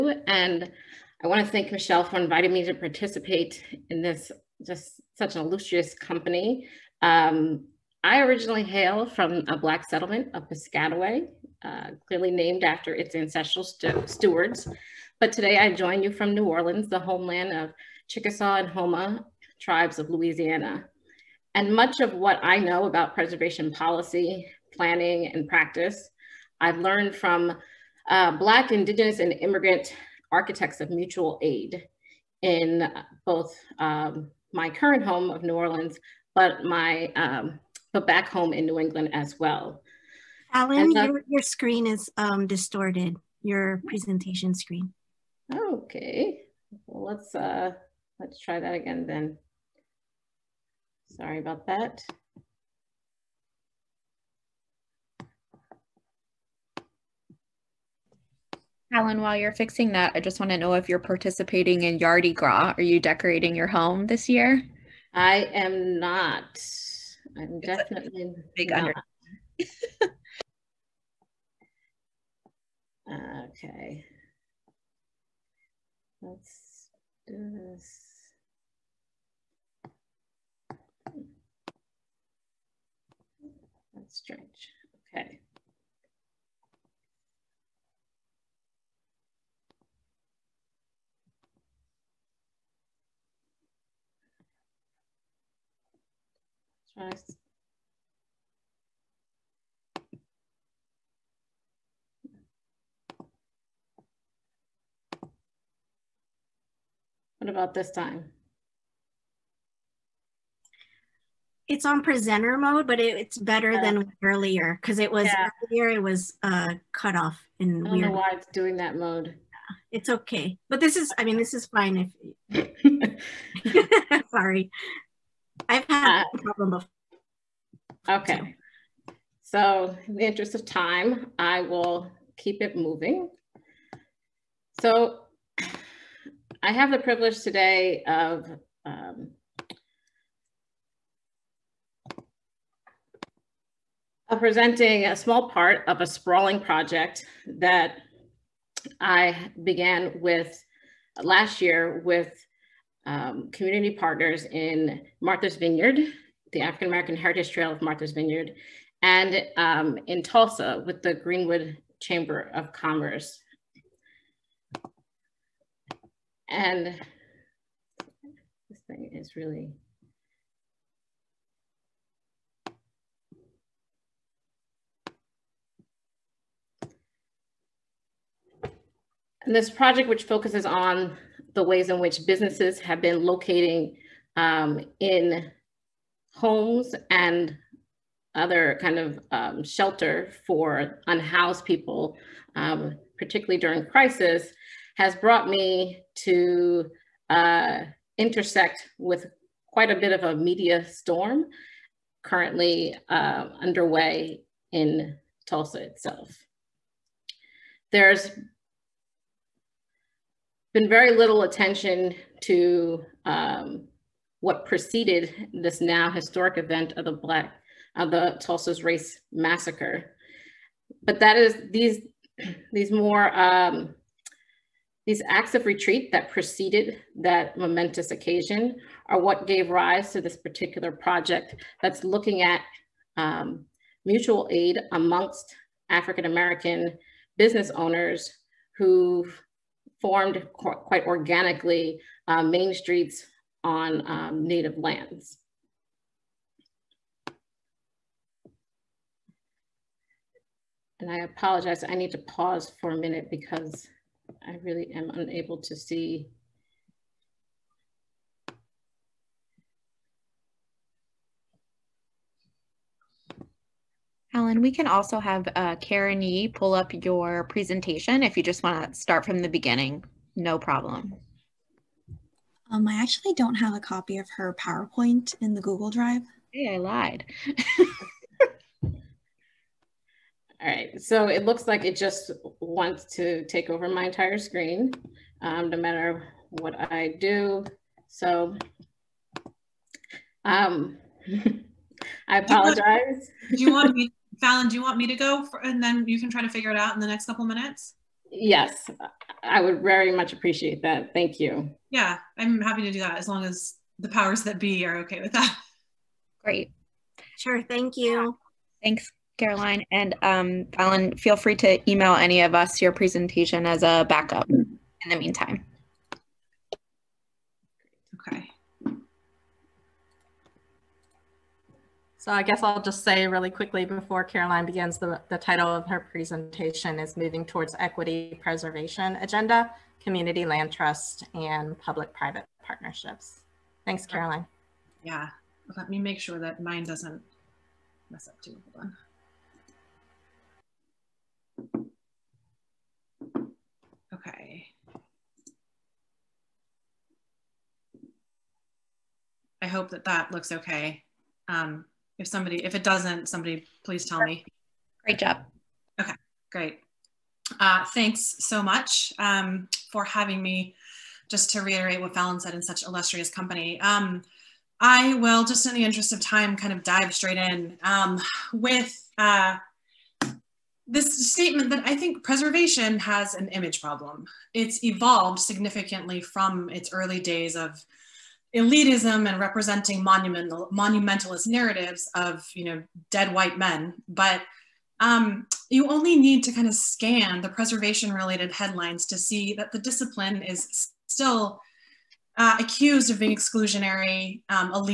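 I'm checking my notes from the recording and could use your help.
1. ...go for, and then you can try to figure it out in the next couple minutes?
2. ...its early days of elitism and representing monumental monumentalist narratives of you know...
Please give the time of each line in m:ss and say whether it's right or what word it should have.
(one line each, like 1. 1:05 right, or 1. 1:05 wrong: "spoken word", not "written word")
1. 4:55 right
2. 6:16 right.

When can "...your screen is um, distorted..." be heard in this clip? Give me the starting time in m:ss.
0:41.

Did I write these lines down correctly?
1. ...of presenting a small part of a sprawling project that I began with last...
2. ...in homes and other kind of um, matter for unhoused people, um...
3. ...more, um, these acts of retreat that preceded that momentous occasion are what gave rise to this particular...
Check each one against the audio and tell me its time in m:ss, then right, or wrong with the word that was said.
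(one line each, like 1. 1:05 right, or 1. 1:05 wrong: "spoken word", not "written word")
1. 2:24 right
2. 3:04 wrong: "shelter", not "matter"
3. 3:42 right.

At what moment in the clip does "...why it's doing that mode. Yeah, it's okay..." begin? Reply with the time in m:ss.
1:58.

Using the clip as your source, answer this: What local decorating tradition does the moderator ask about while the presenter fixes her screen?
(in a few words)
Yardi Gras.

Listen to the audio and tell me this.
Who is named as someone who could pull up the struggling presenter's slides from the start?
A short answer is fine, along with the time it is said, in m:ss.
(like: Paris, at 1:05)
Karen Yee, at 4:25.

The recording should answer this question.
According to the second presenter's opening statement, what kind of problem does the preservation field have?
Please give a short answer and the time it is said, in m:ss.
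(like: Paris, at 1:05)
An image problem, at 6:13.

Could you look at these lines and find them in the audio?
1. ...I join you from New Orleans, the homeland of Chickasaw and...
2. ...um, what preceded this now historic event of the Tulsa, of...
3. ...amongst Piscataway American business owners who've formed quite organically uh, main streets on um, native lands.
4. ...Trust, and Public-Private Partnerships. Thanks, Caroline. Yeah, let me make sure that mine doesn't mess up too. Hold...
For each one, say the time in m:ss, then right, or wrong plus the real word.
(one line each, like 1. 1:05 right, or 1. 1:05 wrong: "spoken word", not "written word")
1. 0:15 right
2. 3:33 wrong: "Black", not "Tulsa"
3. 3:54 wrong: "African", not "Piscataway"
4. 5:30 right.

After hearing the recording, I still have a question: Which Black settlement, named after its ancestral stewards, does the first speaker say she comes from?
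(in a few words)
Piscataway.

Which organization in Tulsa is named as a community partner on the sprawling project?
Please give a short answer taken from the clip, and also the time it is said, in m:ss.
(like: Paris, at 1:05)
Greenwood Chamber of Commerce, at 2:41.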